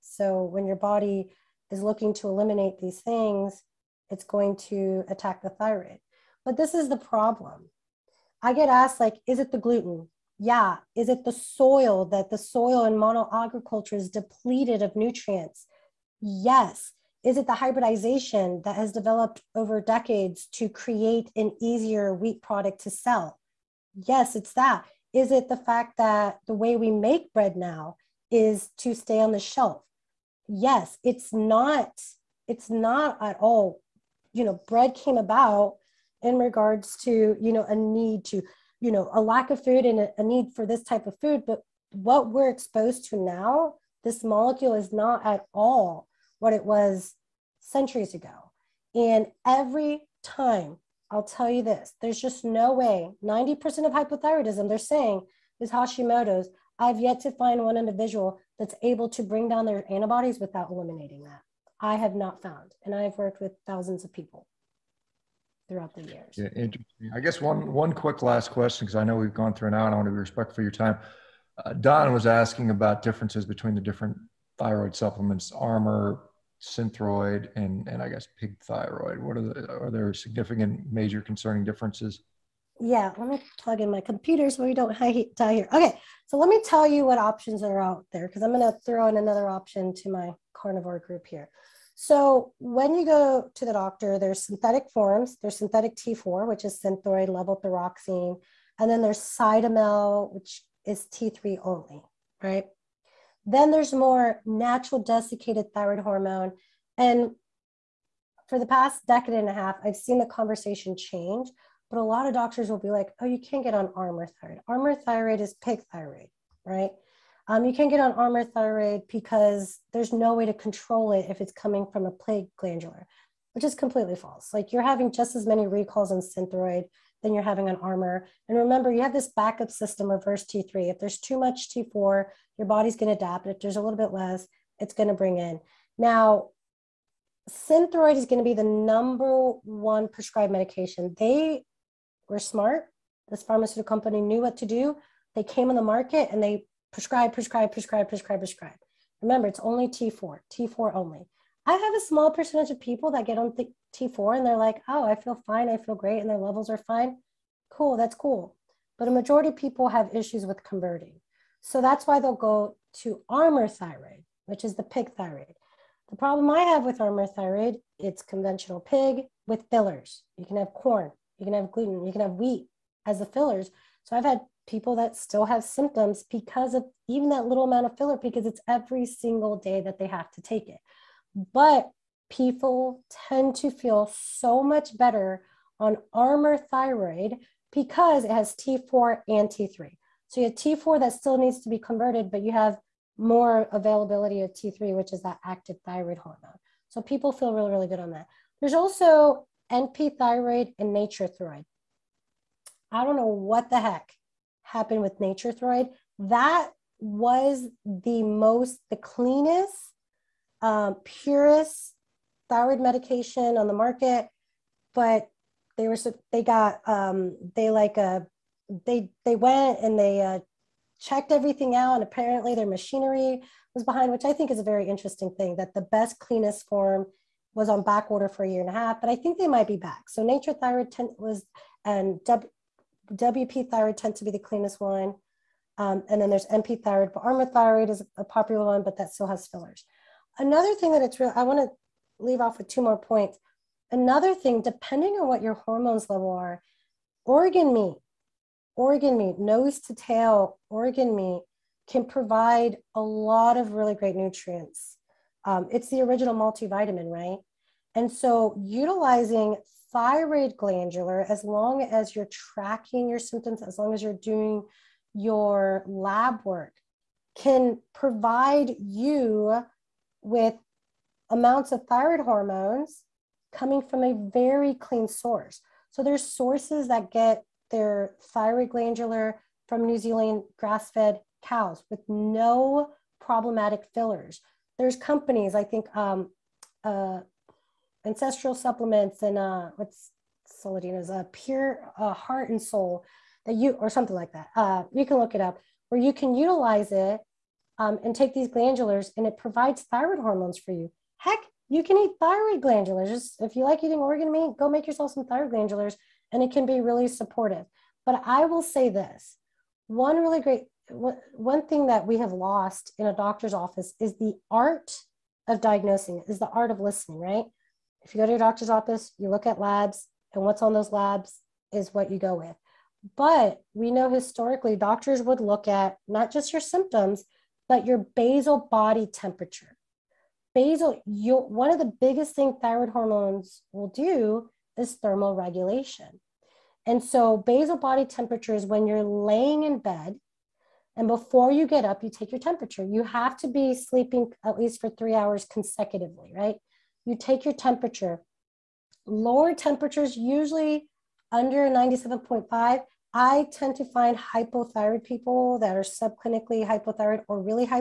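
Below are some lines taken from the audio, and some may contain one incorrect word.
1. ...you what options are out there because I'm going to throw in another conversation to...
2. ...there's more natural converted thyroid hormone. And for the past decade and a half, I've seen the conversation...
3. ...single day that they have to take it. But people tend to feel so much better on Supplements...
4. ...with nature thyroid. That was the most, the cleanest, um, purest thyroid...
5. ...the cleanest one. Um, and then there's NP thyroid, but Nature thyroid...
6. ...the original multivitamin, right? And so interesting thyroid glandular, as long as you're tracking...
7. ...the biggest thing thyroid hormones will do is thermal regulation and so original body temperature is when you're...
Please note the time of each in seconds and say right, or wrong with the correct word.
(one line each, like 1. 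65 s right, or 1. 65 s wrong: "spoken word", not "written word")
1. 86 s wrong: "option", not "conversation"
2. 103 s wrong: "desiccated", not "converted"
3. 179 s wrong: "Armour", not "Supplements"
4. 205 s right
5. 234 s wrong: "Armour", not "Nature"
6. 255 s wrong: "utilizing", not "interesting"
7. 331 s wrong: "basal", not "original".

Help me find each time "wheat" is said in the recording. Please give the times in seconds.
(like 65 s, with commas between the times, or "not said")
22 s, 172 s.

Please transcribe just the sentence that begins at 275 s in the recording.
So there's sources that get their glandular from New Zealand grass fed cows with no problematic fillers.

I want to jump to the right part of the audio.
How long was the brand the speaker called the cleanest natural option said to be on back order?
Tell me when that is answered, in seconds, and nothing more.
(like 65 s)
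228 s.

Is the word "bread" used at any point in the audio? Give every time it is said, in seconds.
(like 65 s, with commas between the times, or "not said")
27 s, 34 s.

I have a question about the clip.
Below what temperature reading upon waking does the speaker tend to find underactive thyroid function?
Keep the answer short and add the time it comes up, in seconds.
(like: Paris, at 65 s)
97.5, at 351 s.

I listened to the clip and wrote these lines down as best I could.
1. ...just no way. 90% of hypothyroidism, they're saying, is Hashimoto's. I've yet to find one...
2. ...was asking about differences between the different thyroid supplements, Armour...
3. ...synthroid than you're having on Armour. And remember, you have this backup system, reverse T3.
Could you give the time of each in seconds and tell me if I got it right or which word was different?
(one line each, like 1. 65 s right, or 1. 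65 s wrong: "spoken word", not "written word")
1. 52 s right
2. 72 s right
3. 126 s right.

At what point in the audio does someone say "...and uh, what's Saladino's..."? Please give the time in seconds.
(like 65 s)
289 s.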